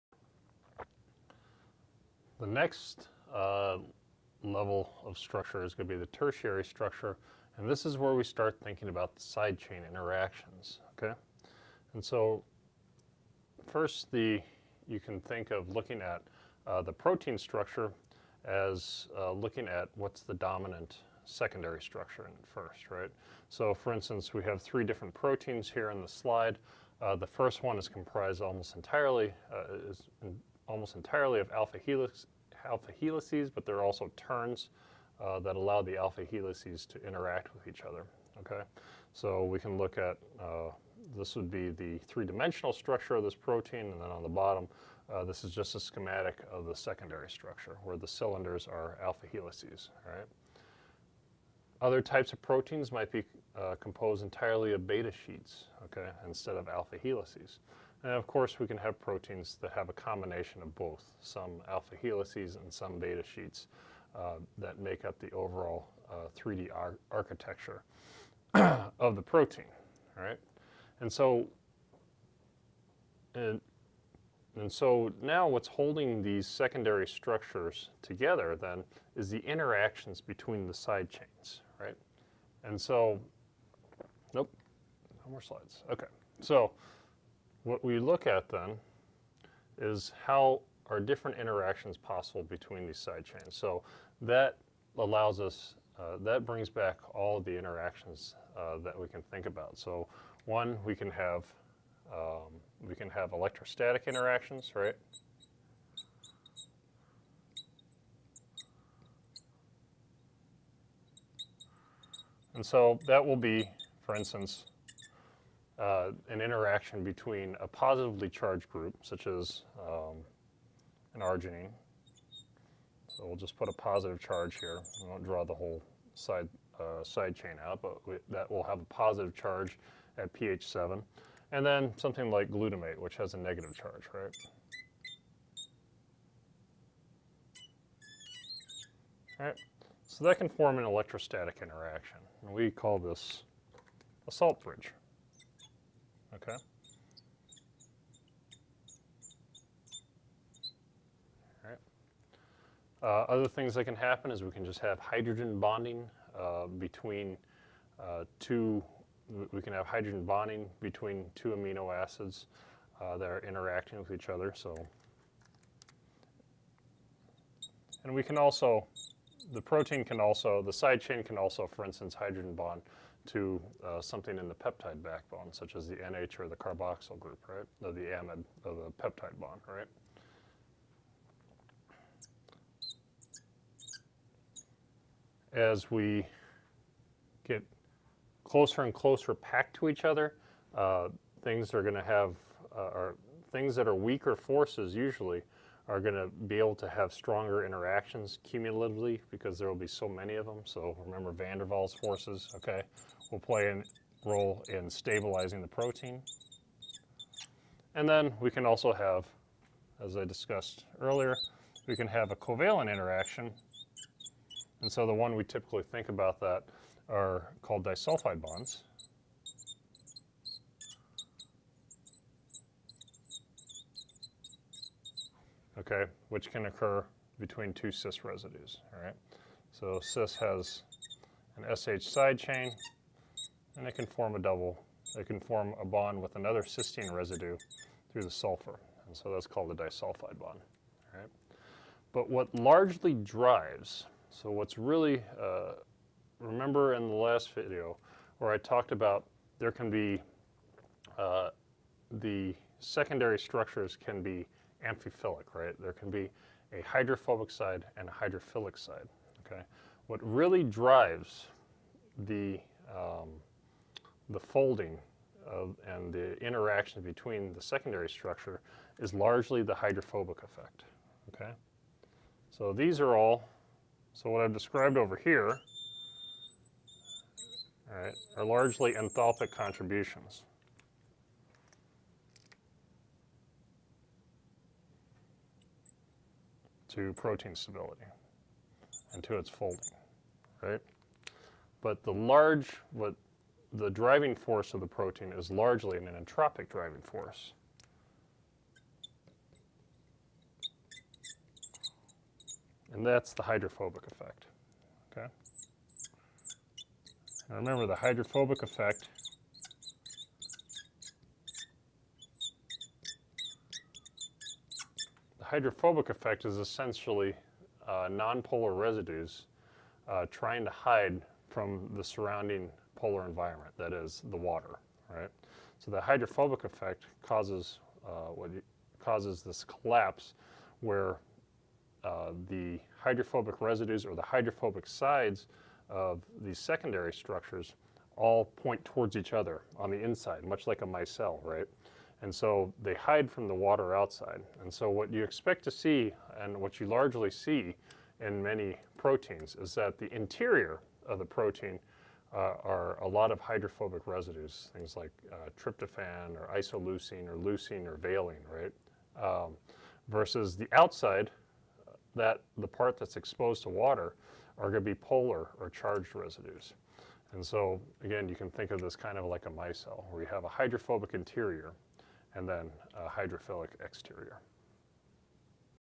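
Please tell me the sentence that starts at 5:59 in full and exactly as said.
Um, versus the outside, that the part that's exposed to water are going to be polar or charged residues.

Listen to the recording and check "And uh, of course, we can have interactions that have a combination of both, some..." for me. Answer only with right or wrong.
wrong.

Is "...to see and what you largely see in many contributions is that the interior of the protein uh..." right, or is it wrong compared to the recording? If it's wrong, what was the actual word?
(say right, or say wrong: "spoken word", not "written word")
wrong: "proteins", not "contributions".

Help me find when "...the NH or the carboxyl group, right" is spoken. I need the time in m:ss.
2:55.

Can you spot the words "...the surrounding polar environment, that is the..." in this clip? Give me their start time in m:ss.
5:21.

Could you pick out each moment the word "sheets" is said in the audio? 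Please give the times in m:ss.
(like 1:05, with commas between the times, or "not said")
0:55, 1:03.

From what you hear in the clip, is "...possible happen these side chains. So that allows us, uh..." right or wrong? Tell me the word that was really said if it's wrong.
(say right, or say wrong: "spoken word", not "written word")
wrong: "between", not "happen".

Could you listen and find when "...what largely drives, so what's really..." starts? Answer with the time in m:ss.
4:02.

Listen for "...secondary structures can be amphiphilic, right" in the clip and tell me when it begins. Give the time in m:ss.
4:12.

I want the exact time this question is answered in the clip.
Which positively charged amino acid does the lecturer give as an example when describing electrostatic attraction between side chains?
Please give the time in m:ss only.
2:01.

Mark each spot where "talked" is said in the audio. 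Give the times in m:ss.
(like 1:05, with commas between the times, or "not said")
4:08.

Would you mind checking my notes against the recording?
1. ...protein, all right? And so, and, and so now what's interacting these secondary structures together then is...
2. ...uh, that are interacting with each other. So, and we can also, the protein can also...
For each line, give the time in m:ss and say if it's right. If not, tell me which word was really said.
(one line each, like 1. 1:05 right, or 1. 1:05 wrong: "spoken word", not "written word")
1. 1:09 wrong: "holding", not "interacting"
2. 2:43 right.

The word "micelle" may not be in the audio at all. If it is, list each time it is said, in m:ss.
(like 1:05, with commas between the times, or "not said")
5:40, 6:09.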